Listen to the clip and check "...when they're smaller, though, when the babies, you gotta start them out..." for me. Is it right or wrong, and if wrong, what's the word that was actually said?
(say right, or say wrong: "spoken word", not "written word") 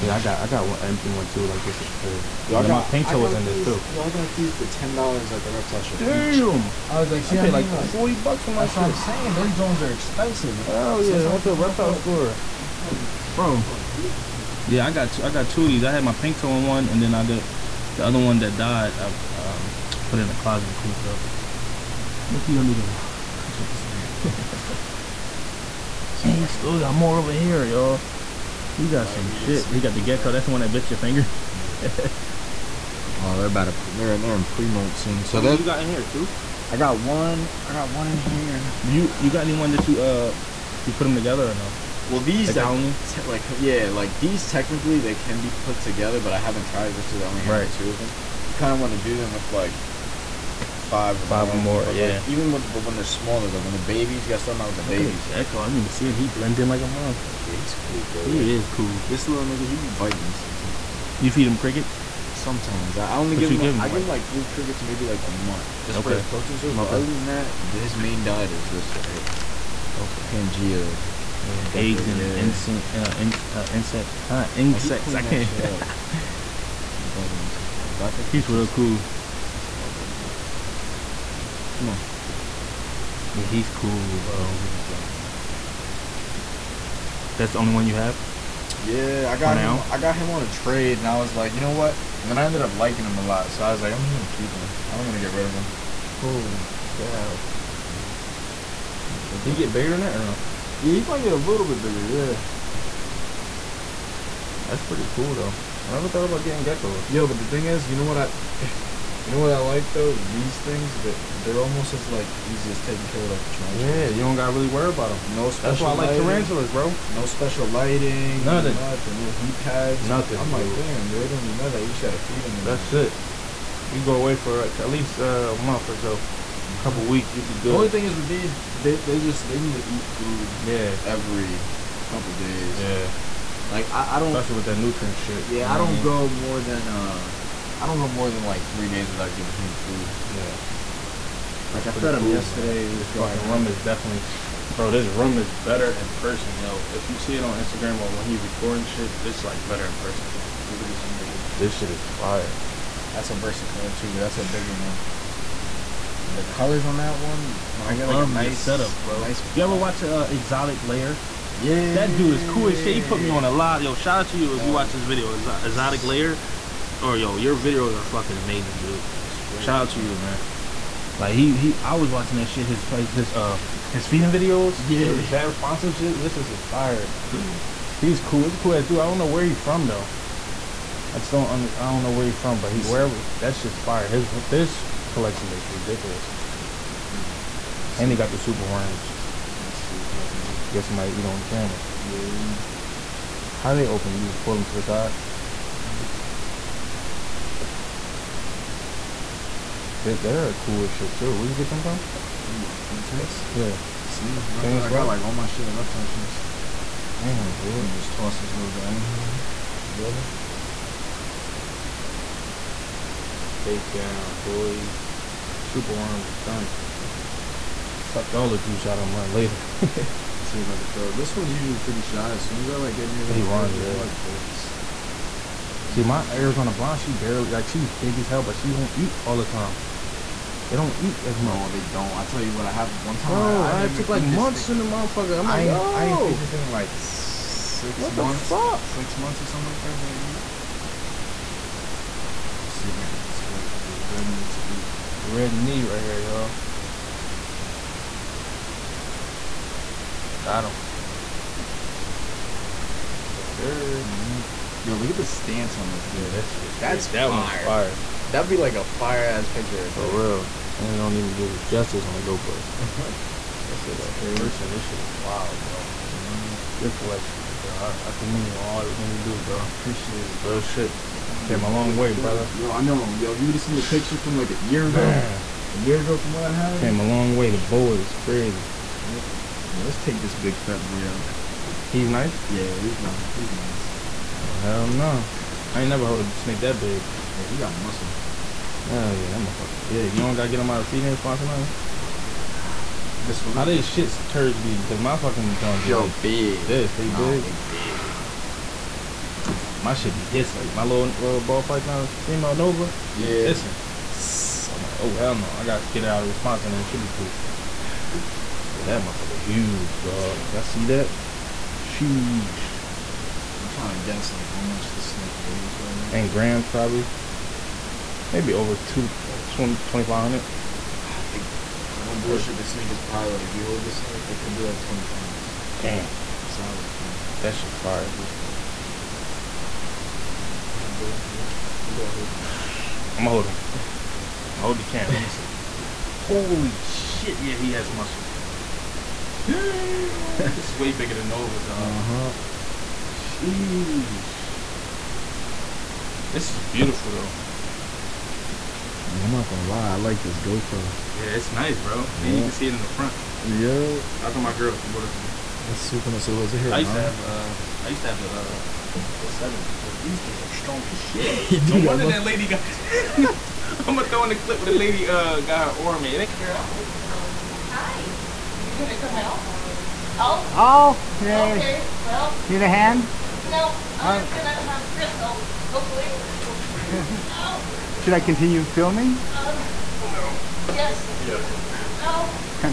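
right.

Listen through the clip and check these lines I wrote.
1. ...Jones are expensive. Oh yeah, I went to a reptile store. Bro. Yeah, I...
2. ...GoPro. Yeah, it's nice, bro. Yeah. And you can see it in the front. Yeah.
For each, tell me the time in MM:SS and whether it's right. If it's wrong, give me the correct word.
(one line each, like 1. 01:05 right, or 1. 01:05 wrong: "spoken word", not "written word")
1. 00:09 right
2. 05:50 right.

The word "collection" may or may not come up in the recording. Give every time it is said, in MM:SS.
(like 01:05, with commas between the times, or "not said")
03:05, 04:26.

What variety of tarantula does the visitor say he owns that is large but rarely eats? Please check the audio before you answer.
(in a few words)
Arizona blonde.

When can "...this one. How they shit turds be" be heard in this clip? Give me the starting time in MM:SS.
04:53.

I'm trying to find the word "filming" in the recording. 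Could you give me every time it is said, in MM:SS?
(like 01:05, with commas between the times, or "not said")
06:18.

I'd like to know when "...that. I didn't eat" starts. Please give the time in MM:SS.
03:59.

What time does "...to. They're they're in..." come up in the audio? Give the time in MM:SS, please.
00:33.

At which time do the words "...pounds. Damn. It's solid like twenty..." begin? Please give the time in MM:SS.
05:25.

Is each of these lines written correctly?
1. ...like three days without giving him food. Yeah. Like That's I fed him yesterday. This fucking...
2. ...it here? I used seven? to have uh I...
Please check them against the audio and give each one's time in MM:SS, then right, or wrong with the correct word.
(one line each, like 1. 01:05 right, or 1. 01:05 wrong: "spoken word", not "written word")
1. 02:18 right
2. 05:56 wrong: "nine", not "seven".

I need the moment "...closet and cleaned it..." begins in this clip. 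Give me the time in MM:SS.
00:20.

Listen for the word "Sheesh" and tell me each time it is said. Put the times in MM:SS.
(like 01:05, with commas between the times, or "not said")
05:11, 05:43.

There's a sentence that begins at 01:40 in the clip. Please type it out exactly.
Yeah, you might get a little bit bigger, yeah.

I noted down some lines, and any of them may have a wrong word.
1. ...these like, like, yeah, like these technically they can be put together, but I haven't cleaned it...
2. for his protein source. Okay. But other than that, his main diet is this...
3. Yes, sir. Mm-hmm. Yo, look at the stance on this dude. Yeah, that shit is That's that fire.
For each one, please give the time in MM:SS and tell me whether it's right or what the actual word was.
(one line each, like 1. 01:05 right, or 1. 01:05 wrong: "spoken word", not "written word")
1. 00:42 wrong: "tried", not "cleaned"
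2. 01:06 right
3. 04:13 right.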